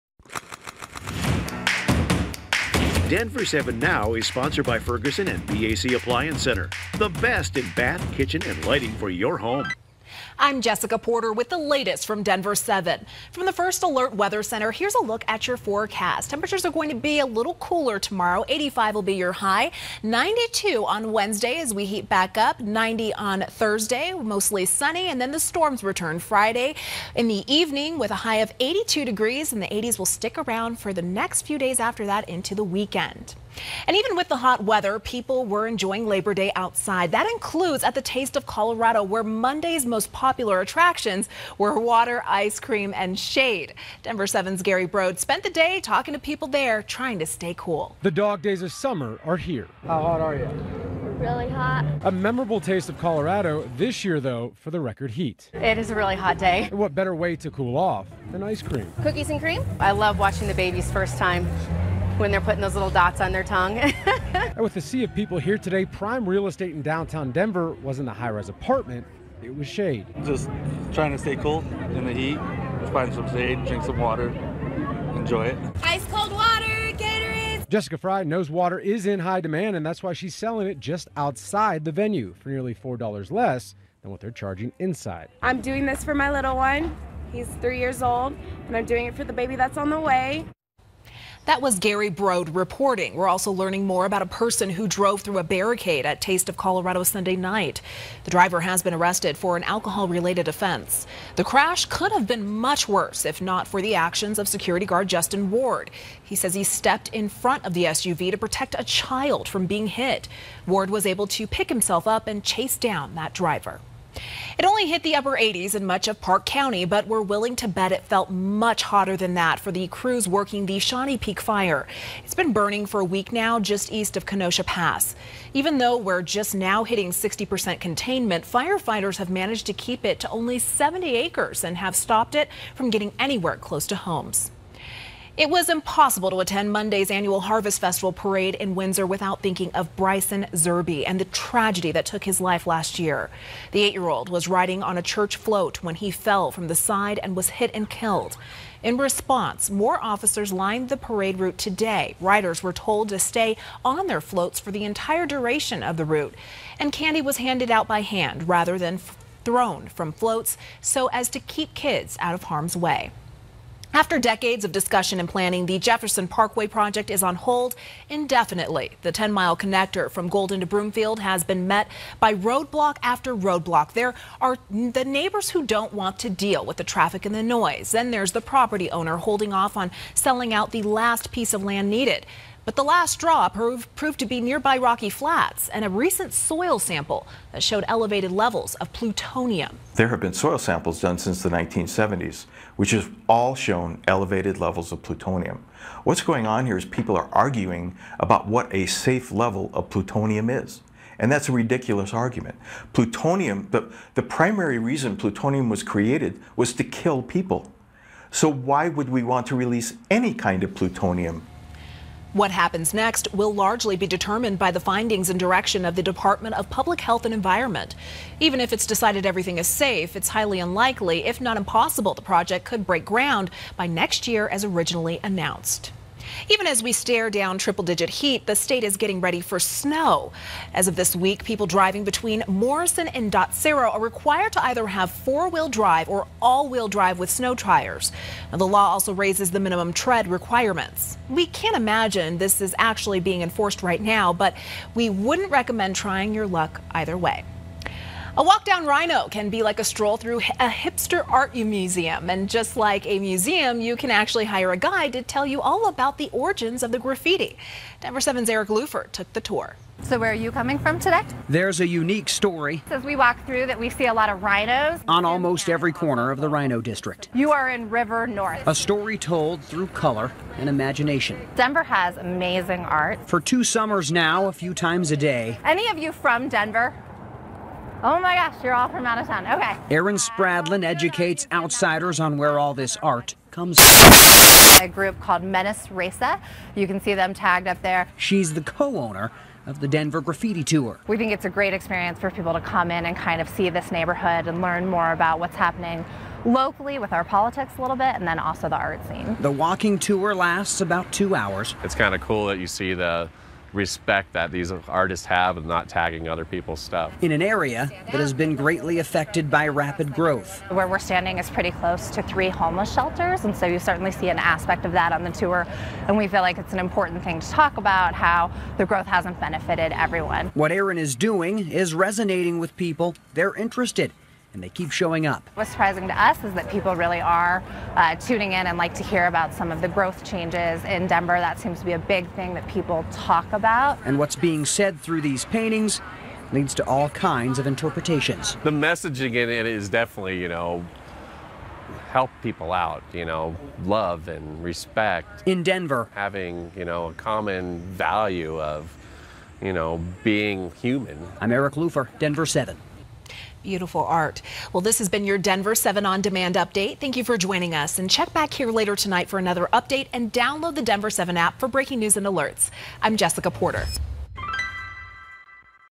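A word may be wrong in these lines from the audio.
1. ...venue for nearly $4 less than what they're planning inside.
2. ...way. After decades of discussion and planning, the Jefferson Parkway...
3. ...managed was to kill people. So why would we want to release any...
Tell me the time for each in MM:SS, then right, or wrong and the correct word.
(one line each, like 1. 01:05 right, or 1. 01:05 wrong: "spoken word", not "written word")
1. 01:21 wrong: "charging", not "planning"
2. 02:42 right
3. 03:25 wrong: "created", not "managed".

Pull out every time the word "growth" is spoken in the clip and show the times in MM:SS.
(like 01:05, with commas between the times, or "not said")
05:10, 05:18, 05:29.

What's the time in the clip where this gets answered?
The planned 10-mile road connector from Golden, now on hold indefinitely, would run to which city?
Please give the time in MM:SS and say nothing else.
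02:50.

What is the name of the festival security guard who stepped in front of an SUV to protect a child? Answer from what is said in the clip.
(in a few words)
Justin Ward.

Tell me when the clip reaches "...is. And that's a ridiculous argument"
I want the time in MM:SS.
03:20.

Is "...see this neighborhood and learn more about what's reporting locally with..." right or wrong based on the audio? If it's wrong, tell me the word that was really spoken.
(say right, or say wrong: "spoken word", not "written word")
wrong: "happening", not "reporting".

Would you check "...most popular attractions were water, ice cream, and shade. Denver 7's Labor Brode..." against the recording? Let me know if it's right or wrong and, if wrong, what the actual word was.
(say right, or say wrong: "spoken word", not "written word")
wrong: "Gary", not "Labor".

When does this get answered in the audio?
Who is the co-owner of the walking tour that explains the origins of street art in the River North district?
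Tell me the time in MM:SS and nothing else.
04:39.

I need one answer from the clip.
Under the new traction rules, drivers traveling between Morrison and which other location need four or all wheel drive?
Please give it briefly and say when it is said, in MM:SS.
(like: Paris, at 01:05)
Dotsero, at 03:53.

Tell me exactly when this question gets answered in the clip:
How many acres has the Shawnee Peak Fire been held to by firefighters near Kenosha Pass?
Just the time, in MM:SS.
02:10.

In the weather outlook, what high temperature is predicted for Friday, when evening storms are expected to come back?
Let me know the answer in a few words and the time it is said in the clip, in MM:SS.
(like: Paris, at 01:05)
82, at 00:28.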